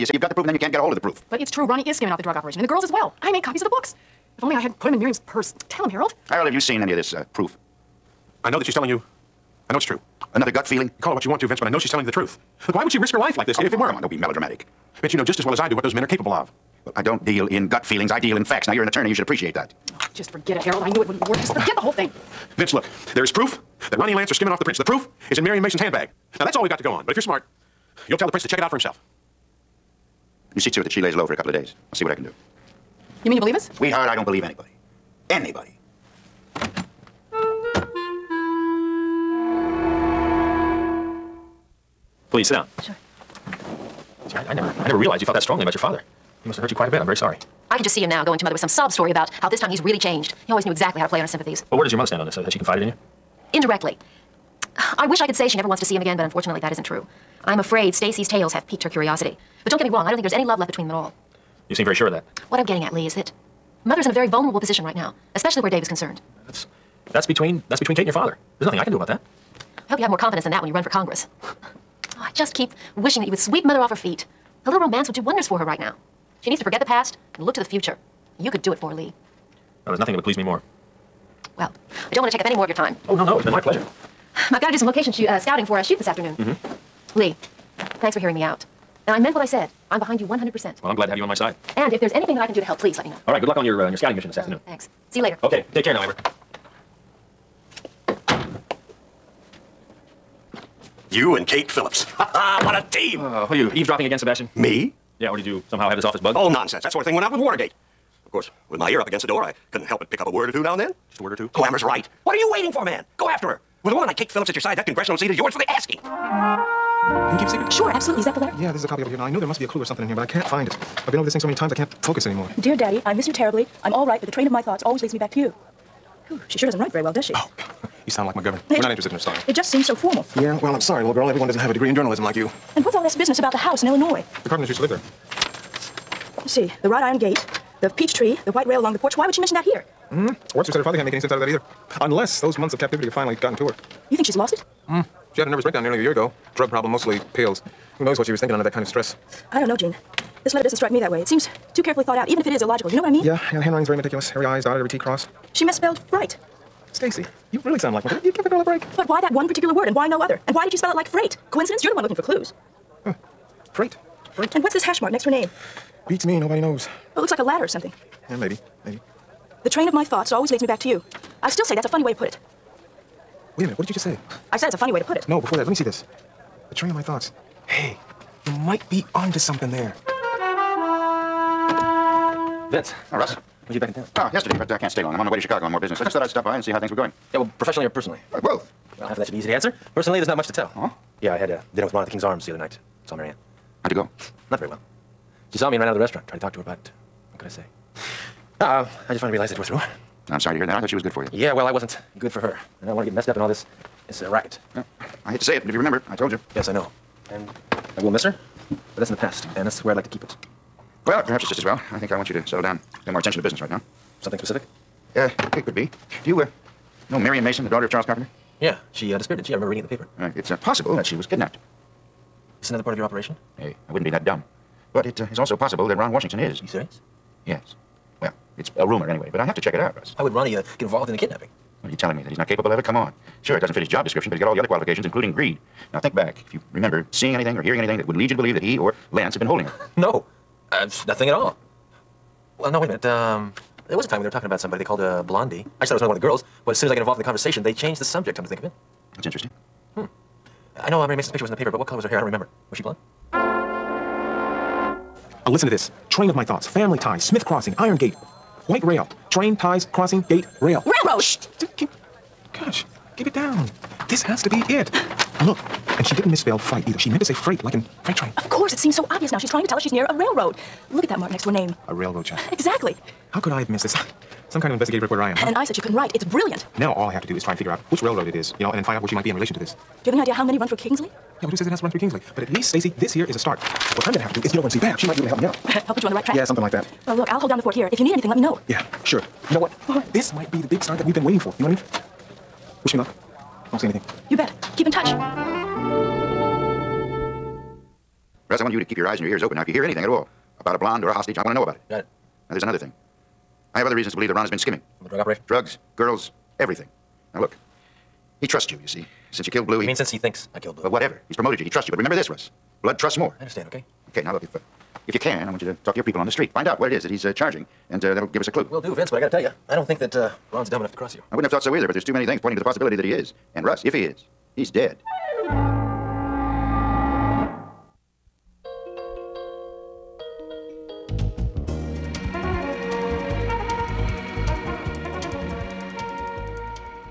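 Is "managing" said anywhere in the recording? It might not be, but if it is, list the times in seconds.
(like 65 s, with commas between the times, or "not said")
not said.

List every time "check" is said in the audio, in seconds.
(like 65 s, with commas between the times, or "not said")
28 s, 229 s.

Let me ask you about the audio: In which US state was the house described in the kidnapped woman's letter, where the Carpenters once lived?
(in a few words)
Illinois.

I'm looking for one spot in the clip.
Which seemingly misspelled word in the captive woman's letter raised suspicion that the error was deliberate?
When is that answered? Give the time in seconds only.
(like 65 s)
155 s.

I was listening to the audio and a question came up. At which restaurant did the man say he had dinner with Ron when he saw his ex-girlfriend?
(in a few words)
King's Arms.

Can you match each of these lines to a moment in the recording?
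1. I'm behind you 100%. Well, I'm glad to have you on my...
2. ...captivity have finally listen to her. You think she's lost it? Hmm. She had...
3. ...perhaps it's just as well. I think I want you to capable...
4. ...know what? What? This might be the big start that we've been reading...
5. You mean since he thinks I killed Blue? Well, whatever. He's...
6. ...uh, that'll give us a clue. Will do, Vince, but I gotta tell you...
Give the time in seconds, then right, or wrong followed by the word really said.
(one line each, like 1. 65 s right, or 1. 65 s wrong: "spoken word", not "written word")
1. 89 s right
2. 142 s wrong: "gotten", not "listen"
3. 211 s wrong: "settle", not "capable"
4. 289 s wrong: "waiting", not "reading"
5. 309 s right
6. 318 s right.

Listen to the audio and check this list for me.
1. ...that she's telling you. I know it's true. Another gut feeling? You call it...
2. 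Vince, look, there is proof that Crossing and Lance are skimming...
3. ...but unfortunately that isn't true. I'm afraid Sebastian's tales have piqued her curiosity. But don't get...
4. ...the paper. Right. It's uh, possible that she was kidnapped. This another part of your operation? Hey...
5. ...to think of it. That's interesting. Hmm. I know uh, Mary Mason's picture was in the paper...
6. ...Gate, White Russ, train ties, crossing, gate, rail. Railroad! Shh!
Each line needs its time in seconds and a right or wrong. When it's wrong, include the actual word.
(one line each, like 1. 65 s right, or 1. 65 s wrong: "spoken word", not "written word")
1. 8 s right
2. 22 s wrong: "Ronnie", not "Crossing"
3. 56 s wrong: "Stacy", not "Sebastian"
4. 219 s right
5. 248 s right
6. 257 s wrong: "Rail", not "Russ".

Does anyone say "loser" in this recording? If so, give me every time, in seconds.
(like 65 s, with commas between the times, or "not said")
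not said.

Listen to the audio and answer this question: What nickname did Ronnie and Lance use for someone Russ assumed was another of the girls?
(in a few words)
Blondie.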